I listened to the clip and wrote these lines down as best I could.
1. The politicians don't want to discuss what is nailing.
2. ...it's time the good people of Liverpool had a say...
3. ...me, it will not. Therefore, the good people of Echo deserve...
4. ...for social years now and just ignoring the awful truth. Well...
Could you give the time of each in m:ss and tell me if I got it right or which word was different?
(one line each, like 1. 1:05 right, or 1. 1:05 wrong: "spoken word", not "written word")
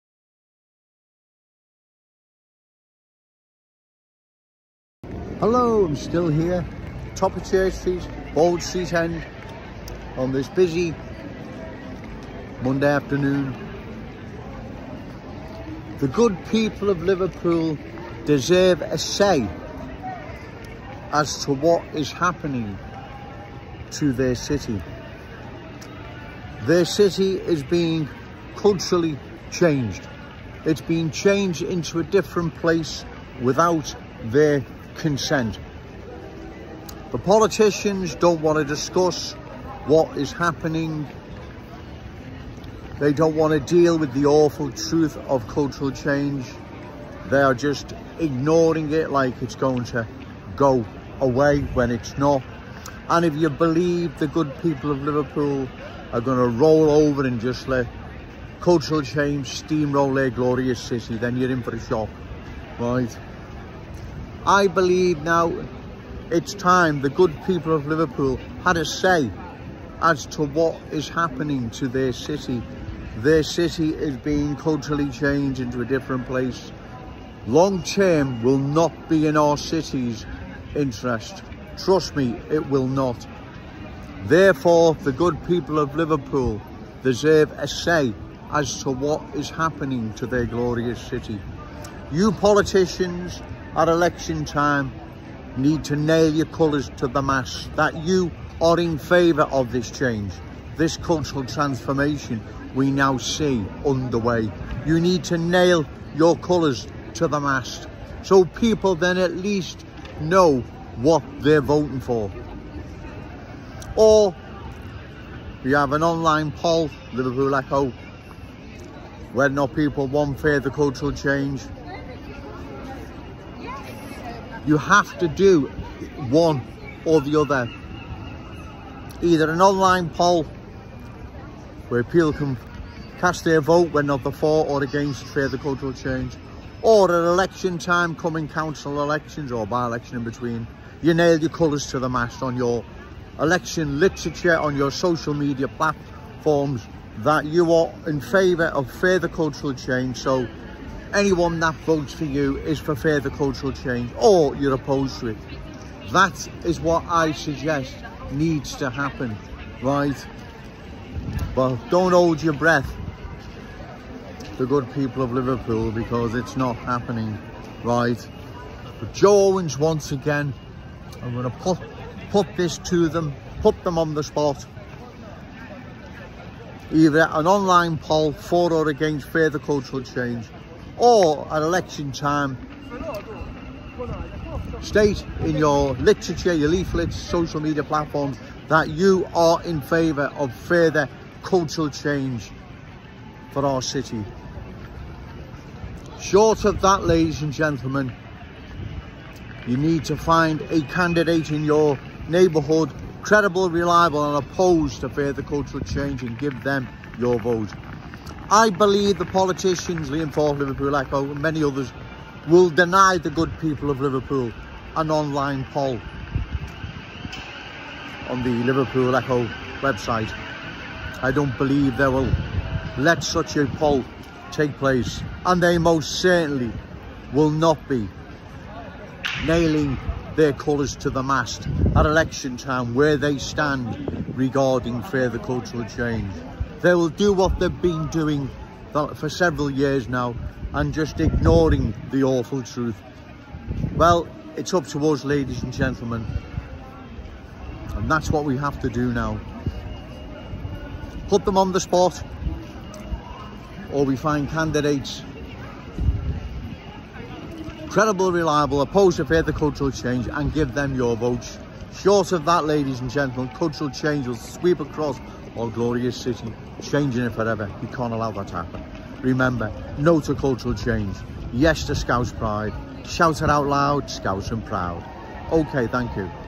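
1. 0:37 wrong: "happening", not "nailing"
2. 1:06 right
3. 1:22 wrong: "Liverpool", not "Echo"
4. 3:59 wrong: "several", not "social".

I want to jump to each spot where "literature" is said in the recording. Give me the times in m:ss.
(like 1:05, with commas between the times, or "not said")
2:23, 3:05.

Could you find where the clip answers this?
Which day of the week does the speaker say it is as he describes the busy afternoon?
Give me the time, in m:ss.
0:12.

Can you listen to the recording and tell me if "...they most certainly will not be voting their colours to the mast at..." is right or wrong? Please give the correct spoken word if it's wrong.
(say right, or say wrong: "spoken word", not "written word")
wrong: "nailing", not "voting".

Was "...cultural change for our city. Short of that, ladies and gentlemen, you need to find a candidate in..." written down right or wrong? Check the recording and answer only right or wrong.
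right.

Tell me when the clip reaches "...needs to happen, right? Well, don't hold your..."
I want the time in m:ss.
2:38.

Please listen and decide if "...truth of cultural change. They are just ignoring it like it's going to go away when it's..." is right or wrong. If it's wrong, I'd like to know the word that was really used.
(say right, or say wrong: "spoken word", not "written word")
right.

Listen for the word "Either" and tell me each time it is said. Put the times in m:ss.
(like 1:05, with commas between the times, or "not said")
2:09, 2:56.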